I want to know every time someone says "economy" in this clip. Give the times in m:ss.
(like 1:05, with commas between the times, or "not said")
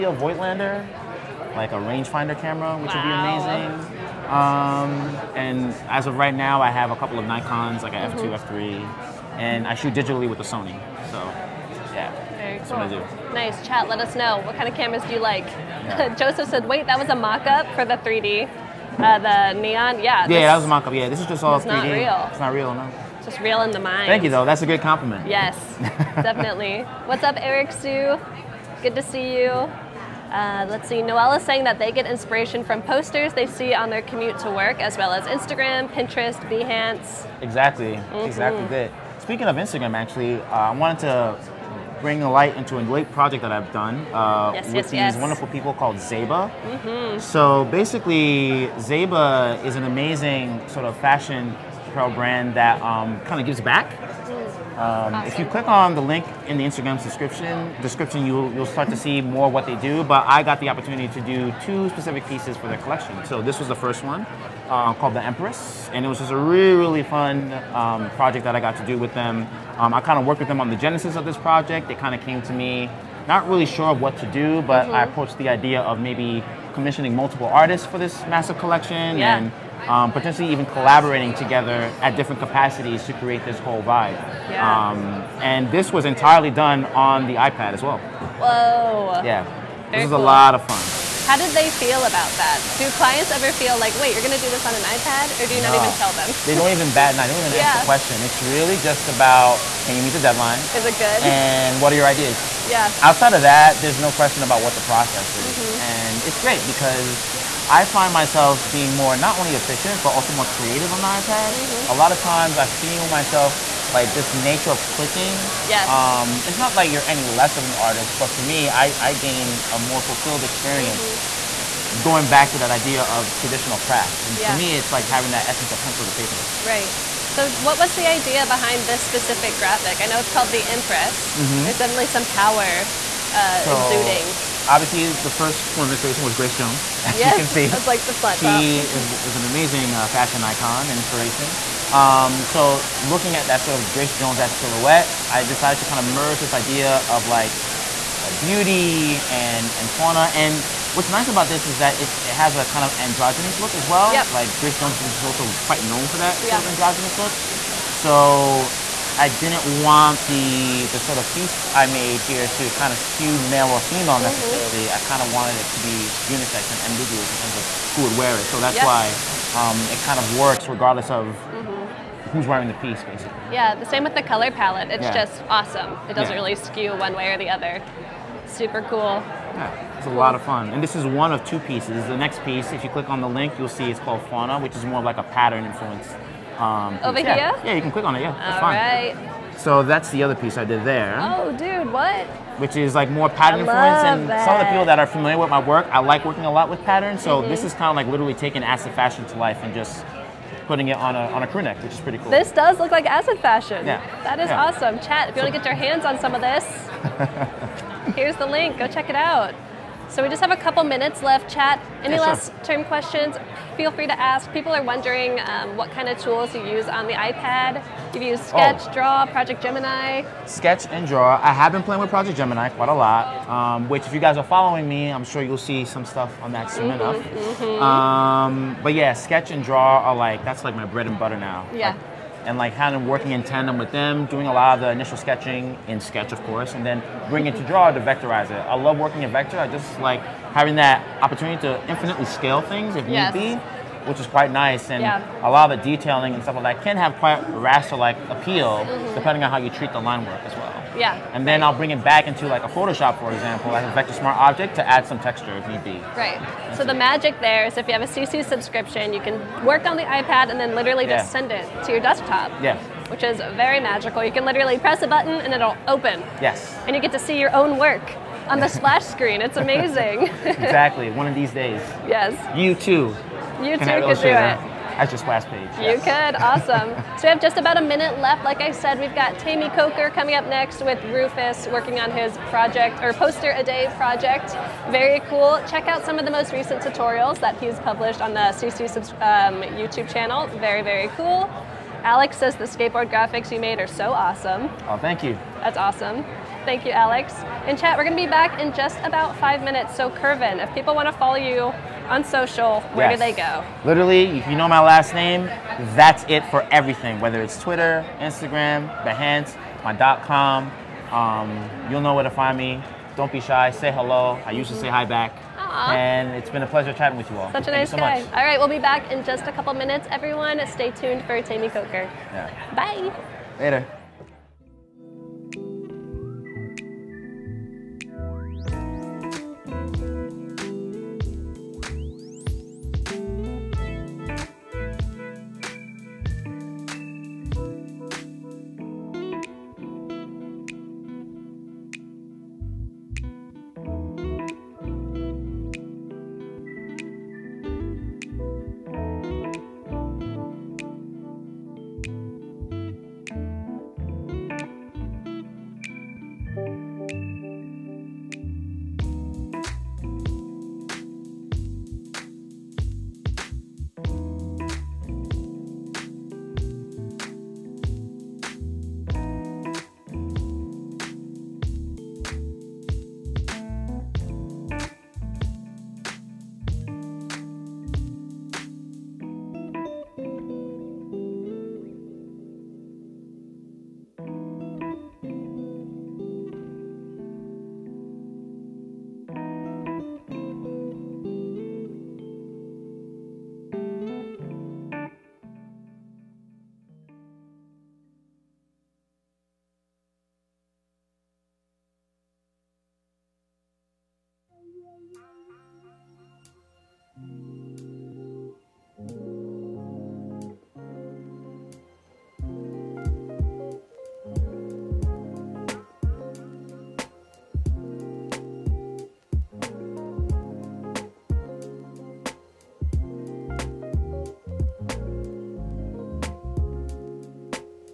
not said.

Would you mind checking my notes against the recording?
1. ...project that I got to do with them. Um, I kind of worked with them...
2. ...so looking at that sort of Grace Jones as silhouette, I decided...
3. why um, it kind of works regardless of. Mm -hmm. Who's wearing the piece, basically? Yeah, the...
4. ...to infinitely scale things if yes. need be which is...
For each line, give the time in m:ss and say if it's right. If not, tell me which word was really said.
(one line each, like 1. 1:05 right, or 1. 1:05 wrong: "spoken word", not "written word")
1. 1:08 right
2. 2:22 right
3. 2:48 right
4. 4:01 right.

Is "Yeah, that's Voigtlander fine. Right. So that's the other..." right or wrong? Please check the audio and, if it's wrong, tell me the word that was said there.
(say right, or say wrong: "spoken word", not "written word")
wrong: "All", not "Voigtlander".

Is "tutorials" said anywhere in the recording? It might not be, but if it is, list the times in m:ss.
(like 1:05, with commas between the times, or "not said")
4:46.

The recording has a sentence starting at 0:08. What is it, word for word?
F2, F3, and I shoot digitally with the Sony.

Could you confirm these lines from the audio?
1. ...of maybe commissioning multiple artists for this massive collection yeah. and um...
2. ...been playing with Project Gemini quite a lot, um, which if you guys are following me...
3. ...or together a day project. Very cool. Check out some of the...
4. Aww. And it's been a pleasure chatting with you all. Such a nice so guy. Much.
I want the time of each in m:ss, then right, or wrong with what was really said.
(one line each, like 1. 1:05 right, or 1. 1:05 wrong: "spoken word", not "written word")
1. 1:15 right
2. 3:41 right
3. 4:43 wrong: "poster", not "together"
4. 5:15 right.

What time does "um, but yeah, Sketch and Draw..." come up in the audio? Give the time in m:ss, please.
3:48.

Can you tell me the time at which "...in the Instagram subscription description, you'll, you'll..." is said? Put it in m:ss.
0:56.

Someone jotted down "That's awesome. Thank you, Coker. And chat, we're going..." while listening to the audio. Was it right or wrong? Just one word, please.
wrong.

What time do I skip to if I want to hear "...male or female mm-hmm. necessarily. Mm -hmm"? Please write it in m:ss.
2:43.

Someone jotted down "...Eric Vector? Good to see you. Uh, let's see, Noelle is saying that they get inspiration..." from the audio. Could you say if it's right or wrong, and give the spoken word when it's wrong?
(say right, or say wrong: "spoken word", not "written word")
wrong: "Sue", not "Vector".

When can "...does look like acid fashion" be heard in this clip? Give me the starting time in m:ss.
3:22.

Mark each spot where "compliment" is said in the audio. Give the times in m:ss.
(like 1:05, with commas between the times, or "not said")
0:24.